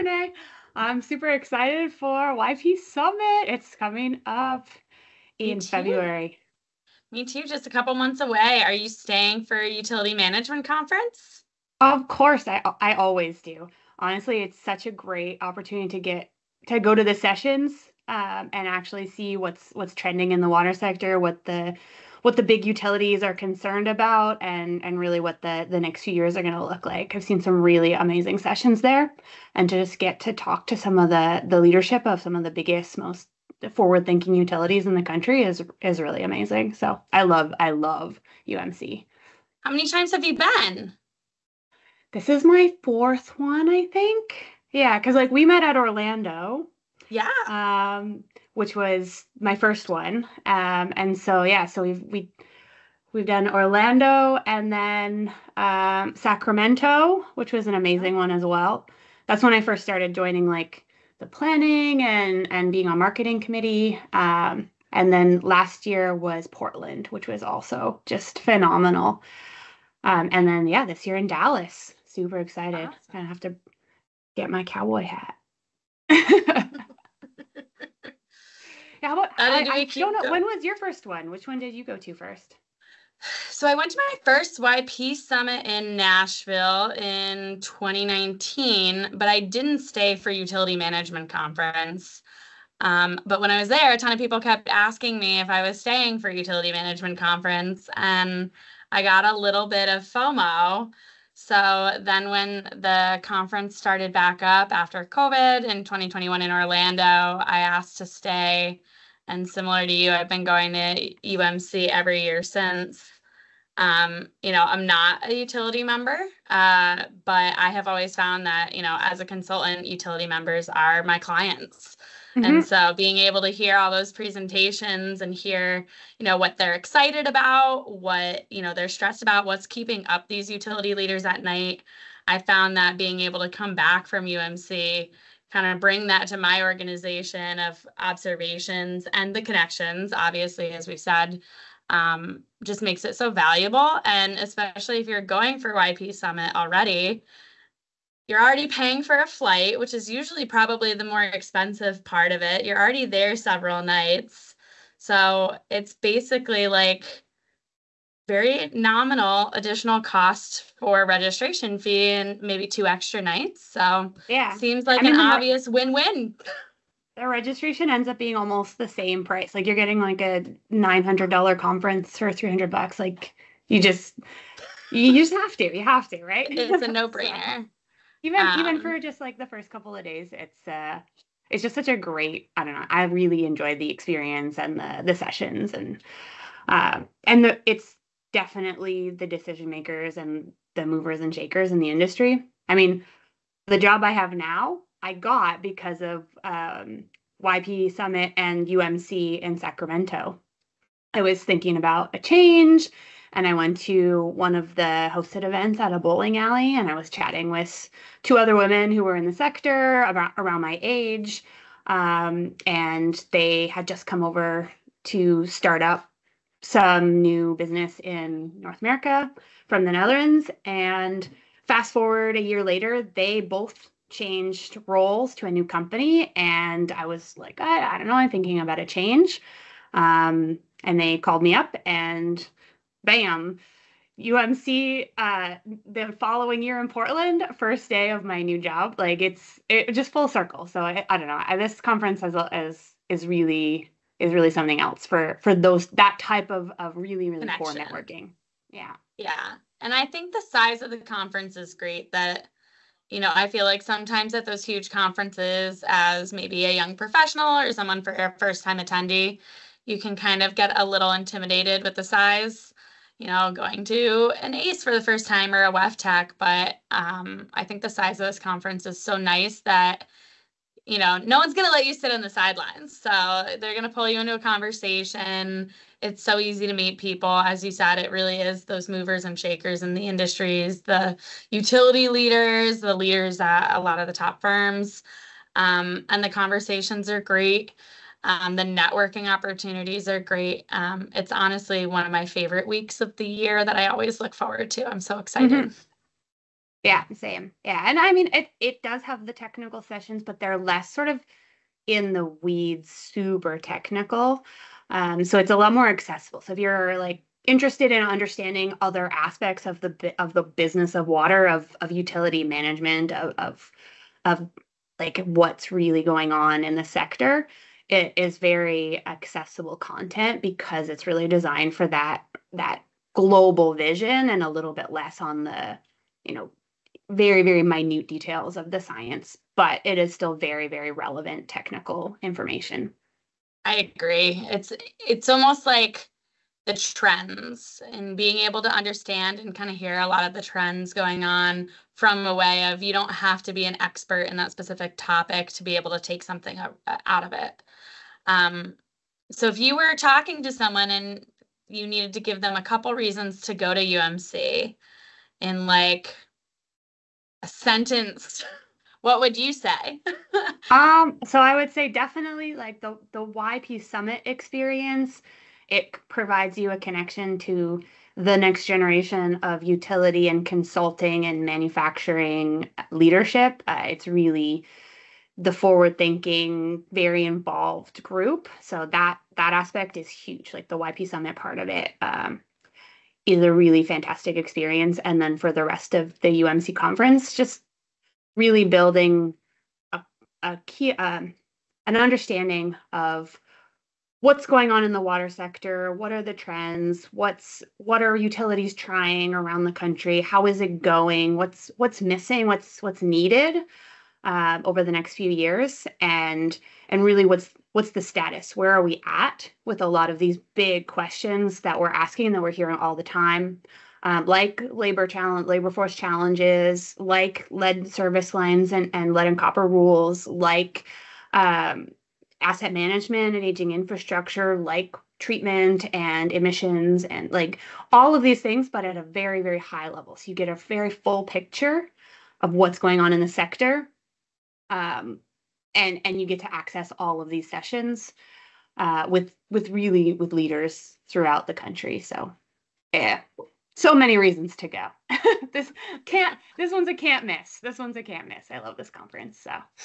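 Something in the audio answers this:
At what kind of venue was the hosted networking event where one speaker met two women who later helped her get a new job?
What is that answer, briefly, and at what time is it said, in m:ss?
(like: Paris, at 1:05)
A bowling alley, at 3:25.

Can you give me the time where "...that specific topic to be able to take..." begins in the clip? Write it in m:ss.
5:44.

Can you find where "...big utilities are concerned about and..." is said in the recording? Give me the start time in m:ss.
0:22.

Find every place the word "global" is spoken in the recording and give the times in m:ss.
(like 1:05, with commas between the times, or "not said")
5:23.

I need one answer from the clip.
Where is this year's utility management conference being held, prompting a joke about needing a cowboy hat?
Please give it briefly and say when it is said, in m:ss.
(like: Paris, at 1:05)
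Dallas, at 1:11.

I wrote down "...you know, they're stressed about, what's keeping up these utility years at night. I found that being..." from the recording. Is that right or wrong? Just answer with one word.
wrong.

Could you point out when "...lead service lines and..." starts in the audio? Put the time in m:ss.
6:57.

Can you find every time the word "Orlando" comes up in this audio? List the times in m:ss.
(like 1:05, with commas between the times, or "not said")
0:45, 0:53, 1:46.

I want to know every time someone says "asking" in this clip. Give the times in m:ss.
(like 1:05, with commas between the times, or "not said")
1:34, 6:51.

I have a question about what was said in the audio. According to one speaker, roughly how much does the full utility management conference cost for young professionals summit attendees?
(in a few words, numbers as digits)
$300.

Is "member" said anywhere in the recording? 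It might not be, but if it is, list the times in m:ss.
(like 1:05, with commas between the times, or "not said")
1:55, 2:00.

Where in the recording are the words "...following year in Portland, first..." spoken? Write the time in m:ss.
3:56.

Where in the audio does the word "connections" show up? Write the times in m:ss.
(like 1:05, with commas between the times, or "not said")
2:19, 4:07, 6:06.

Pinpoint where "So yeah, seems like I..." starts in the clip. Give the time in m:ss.
2:43.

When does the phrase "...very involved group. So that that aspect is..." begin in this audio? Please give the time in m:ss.
6:16.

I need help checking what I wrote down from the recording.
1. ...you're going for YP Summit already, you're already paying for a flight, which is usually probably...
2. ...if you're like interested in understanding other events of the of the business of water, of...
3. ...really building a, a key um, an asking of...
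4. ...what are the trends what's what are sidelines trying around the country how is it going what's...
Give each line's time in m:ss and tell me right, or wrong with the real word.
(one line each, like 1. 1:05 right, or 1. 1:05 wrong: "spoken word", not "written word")
1. 2:25 right
2. 5:06 wrong: "aspects", not "events"
3. 6:28 wrong: "understanding", not "asking"
4. 6:35 wrong: "utilities", not "sidelines".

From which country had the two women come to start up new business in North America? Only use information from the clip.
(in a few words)
The Netherlands.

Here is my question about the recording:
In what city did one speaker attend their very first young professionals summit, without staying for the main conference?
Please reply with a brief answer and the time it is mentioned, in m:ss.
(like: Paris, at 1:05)
Nashville, at 1:25.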